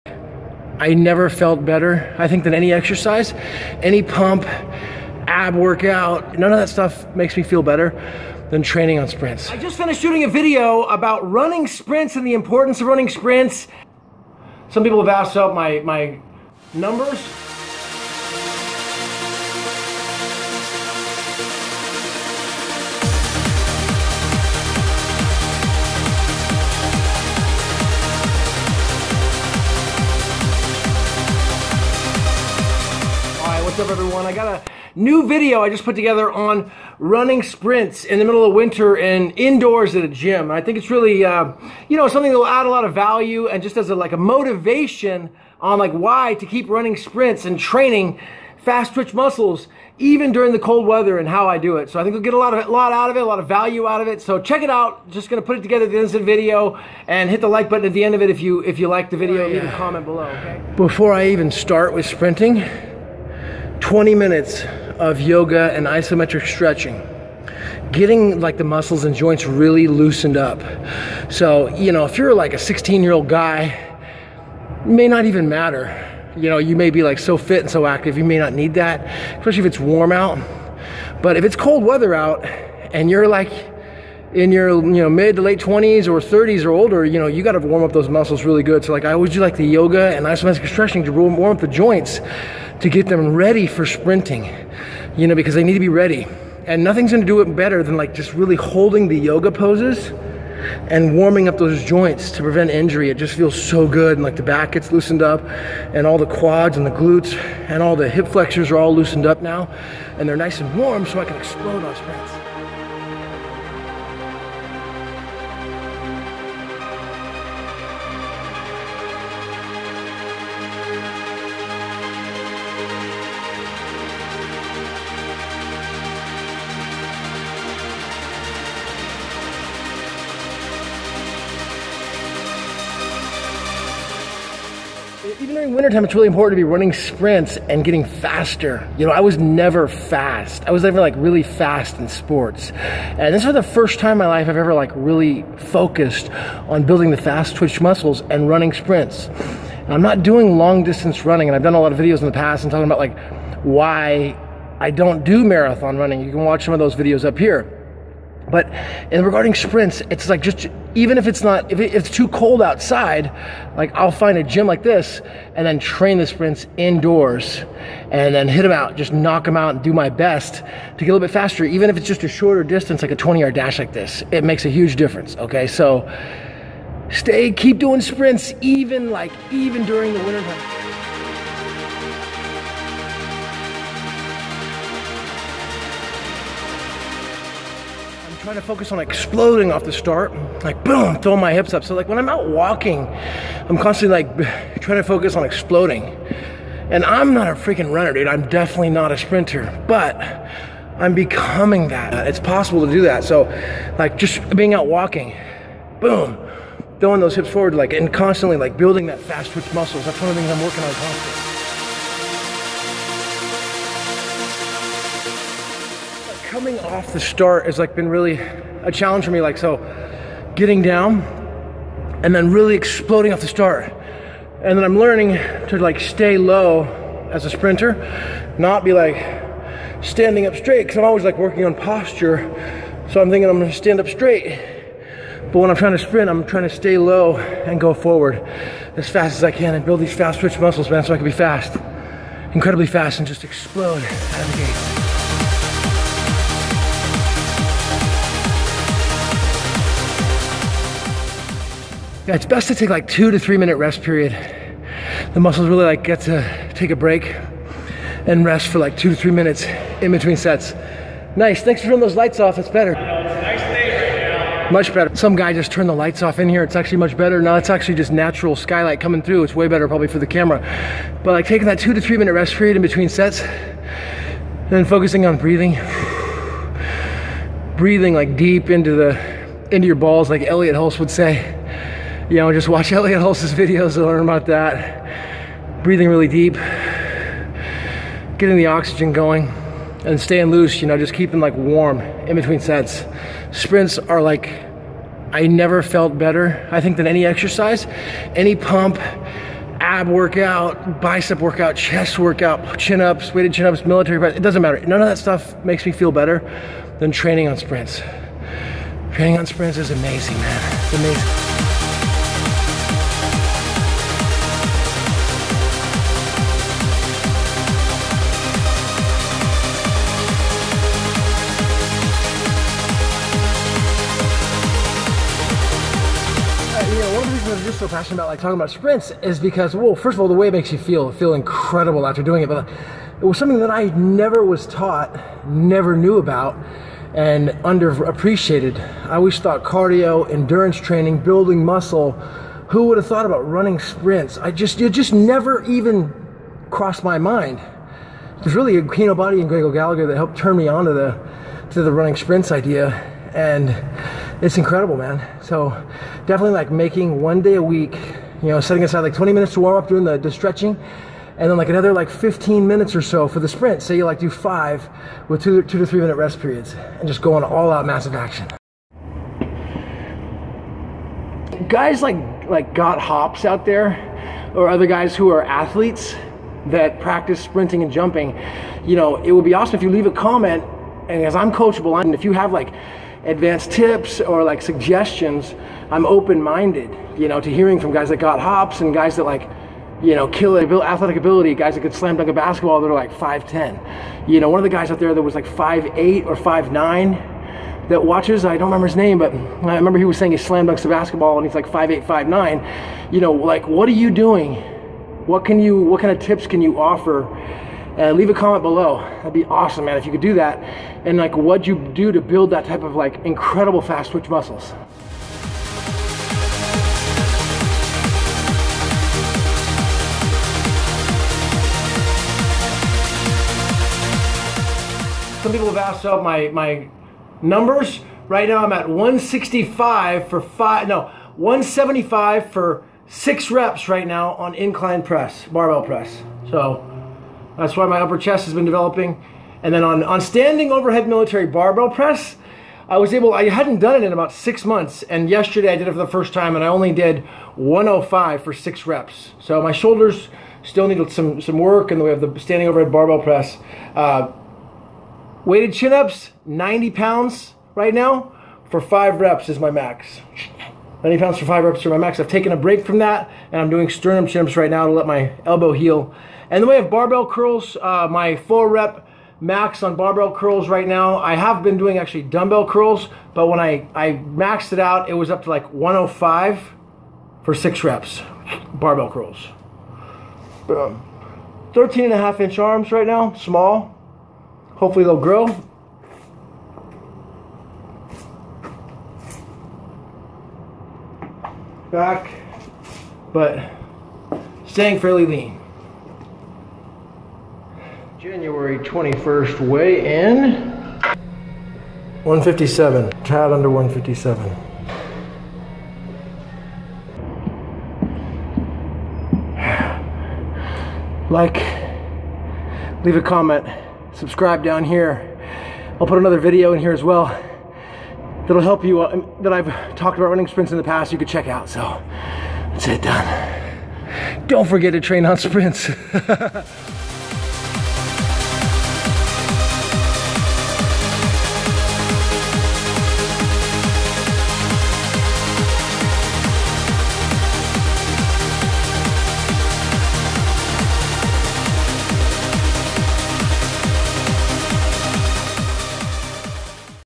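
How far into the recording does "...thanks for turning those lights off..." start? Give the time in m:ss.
4:21.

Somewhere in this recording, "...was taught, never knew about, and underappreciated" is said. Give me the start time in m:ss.
5:34.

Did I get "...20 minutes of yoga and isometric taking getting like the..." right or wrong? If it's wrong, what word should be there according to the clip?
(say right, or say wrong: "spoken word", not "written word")
wrong: "stretching", not "taking".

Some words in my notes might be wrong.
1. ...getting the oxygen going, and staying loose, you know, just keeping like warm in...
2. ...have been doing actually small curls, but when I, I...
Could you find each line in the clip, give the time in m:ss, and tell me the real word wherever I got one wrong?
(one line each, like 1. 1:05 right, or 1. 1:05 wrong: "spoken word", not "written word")
1. 4:48 right
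2. 7:51 wrong: "dumbbell", not "small".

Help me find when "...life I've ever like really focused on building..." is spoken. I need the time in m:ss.
2:24.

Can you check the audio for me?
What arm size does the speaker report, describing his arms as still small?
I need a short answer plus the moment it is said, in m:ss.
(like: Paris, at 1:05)
13.5 inches, at 8:01.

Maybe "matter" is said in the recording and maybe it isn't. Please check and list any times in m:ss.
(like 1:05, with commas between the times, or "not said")
1:15, 5:04.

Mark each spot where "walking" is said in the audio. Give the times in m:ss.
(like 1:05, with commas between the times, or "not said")
3:12, 3:24.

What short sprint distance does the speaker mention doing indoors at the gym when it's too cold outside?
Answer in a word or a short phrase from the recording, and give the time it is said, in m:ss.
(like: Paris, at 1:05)
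20 yard dash, at 2:53.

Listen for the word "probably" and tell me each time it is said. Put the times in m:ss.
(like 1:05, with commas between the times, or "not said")
4:29.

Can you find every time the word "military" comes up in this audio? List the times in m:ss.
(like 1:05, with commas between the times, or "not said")
5:03, 7:21.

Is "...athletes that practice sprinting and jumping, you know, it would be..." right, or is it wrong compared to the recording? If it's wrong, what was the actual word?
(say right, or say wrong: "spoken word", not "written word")
right.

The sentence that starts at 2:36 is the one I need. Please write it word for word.
You can watch some of those videos up here.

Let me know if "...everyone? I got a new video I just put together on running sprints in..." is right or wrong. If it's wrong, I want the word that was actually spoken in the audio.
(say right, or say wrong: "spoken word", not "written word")
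right.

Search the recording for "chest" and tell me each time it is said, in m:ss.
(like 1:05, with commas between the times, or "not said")
5:01, 7:18.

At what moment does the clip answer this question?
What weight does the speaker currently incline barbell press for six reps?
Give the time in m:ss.
7:11.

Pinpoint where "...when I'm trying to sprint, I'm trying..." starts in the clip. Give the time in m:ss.
3:55.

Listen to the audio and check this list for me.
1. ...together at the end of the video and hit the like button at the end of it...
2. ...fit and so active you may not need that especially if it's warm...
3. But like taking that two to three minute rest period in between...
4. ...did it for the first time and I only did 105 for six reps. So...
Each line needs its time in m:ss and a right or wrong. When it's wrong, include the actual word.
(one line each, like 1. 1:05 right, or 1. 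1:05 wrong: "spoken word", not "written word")
1. 0:55 right
2. 1:17 right
3. 4:31 right
4. 7:25 right.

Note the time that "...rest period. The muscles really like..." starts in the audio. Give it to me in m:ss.
4:13.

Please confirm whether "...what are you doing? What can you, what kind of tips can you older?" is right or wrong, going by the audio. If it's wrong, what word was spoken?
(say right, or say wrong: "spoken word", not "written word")
wrong: "offer", not "older".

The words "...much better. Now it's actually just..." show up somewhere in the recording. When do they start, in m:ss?
4:26.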